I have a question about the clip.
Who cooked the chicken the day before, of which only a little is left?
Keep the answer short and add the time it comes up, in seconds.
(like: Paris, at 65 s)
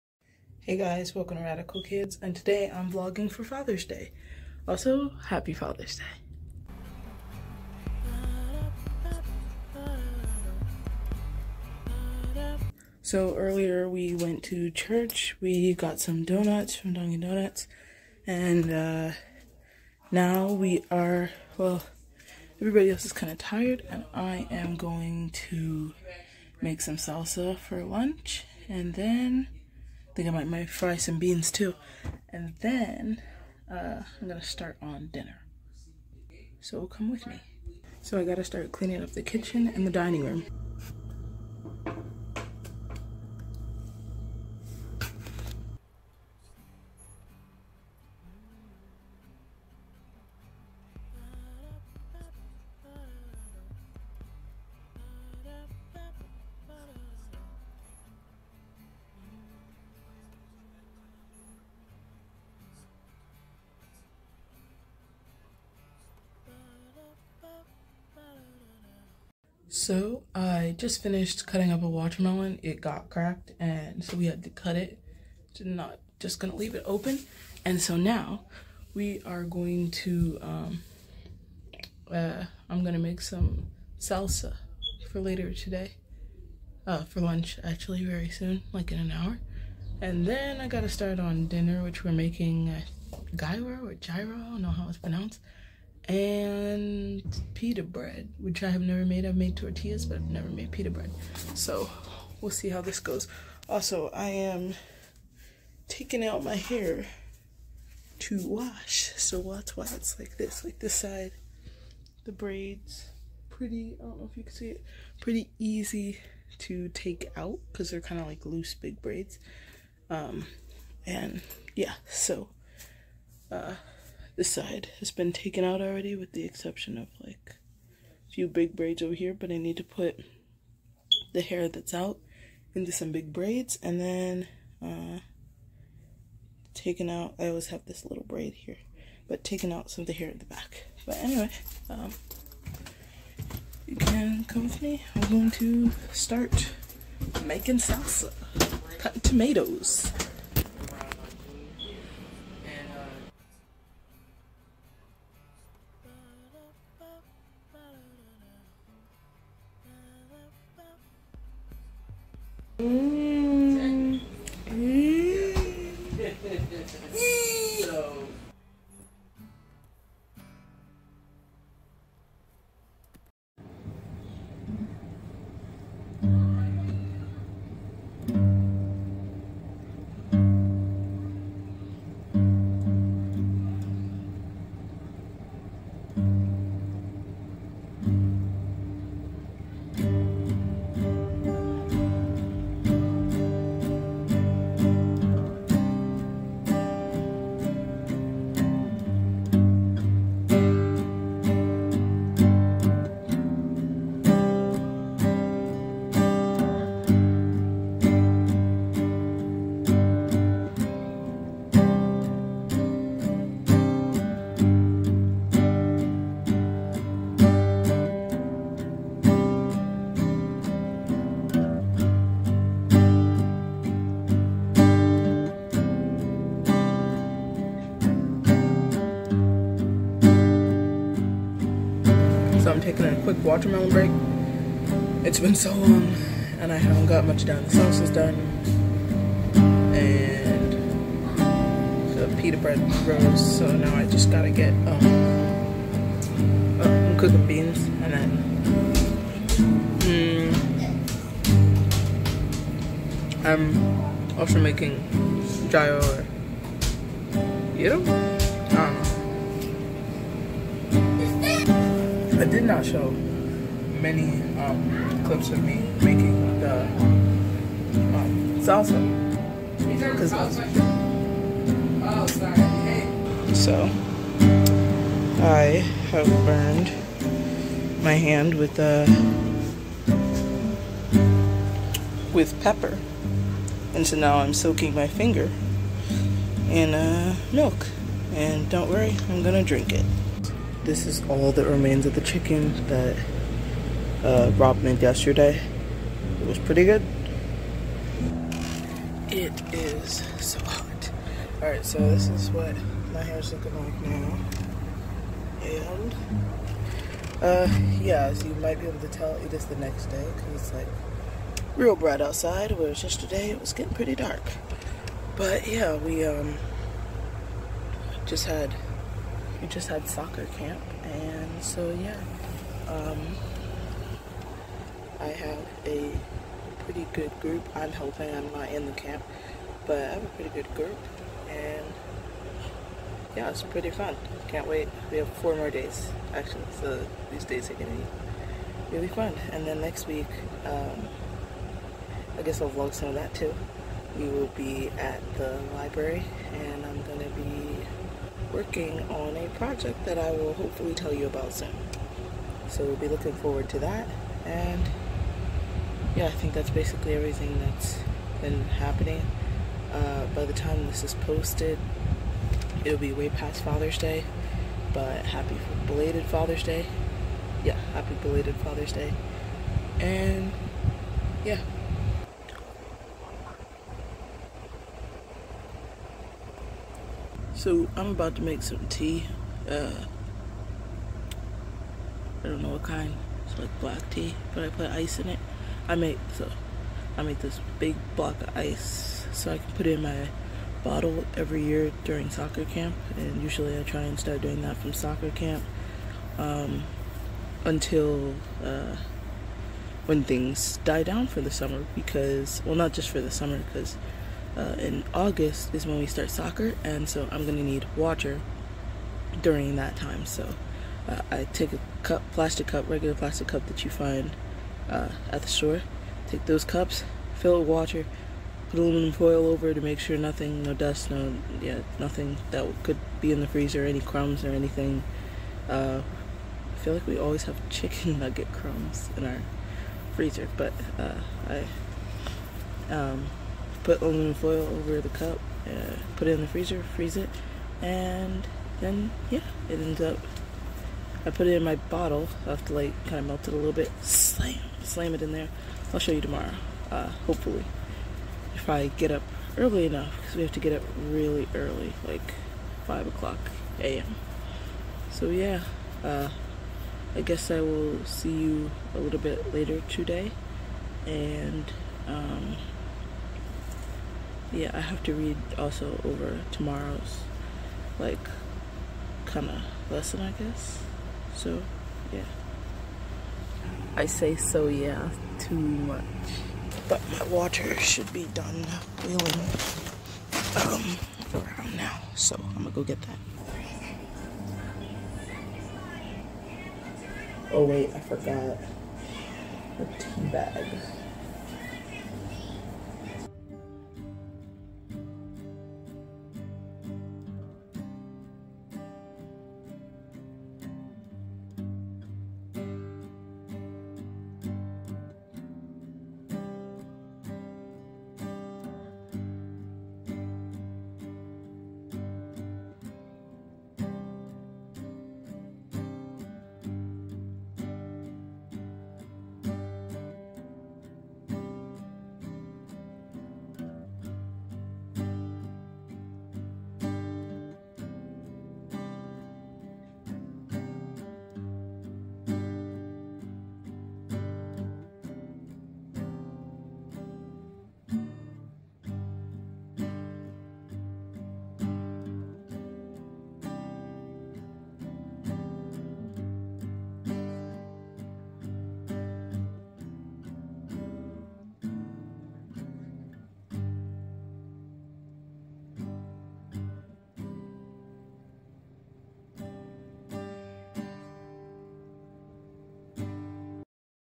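Rob, at 294 s.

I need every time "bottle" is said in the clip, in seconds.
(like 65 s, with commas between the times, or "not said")
390 s, 441 s.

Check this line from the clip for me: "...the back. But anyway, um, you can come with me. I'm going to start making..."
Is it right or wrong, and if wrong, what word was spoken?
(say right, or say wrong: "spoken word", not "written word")
right.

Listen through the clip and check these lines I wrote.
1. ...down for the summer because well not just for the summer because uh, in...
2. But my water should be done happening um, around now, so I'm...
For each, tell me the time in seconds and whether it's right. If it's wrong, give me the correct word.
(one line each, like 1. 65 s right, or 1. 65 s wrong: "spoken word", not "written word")
1. 401 s right
2. 476 s wrong: "boiling", not "happening".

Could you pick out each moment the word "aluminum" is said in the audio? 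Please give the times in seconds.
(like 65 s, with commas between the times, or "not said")
418 s, 434 s.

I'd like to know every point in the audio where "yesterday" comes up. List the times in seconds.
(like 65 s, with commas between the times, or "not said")
295 s, 313 s.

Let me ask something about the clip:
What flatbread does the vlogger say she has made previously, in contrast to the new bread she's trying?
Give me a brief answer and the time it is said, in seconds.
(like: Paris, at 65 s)
Tortillas, at 99 s.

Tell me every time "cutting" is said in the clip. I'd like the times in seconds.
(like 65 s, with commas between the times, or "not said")
71 s, 148 s.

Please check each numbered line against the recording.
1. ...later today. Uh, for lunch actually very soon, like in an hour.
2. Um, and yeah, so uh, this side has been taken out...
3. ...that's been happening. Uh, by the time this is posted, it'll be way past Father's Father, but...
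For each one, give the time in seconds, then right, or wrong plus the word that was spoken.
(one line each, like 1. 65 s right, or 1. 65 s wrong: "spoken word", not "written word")
1. 85 s right
2. 120 s right
3. 357 s wrong: "Day", not "Father".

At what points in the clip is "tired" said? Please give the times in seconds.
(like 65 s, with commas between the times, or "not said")
23 s.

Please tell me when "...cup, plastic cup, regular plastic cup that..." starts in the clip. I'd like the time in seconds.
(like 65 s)
412 s.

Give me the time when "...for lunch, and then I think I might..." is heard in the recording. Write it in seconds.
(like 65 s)
27 s.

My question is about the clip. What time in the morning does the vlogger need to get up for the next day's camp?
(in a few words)
5 a.m.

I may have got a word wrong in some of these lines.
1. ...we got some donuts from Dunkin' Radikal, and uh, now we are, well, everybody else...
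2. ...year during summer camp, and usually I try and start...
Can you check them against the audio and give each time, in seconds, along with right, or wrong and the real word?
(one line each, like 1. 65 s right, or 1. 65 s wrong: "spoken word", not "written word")
1. 15 s wrong: "Donuts", not "Radikal"
2. 391 s wrong: "soccer", not "summer".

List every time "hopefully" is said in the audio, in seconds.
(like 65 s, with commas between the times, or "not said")
350 s, 447 s.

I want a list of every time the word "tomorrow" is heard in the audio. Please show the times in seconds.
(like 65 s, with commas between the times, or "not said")
446 s, 466 s.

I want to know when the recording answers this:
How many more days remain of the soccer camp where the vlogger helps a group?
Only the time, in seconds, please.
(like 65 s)
335 s.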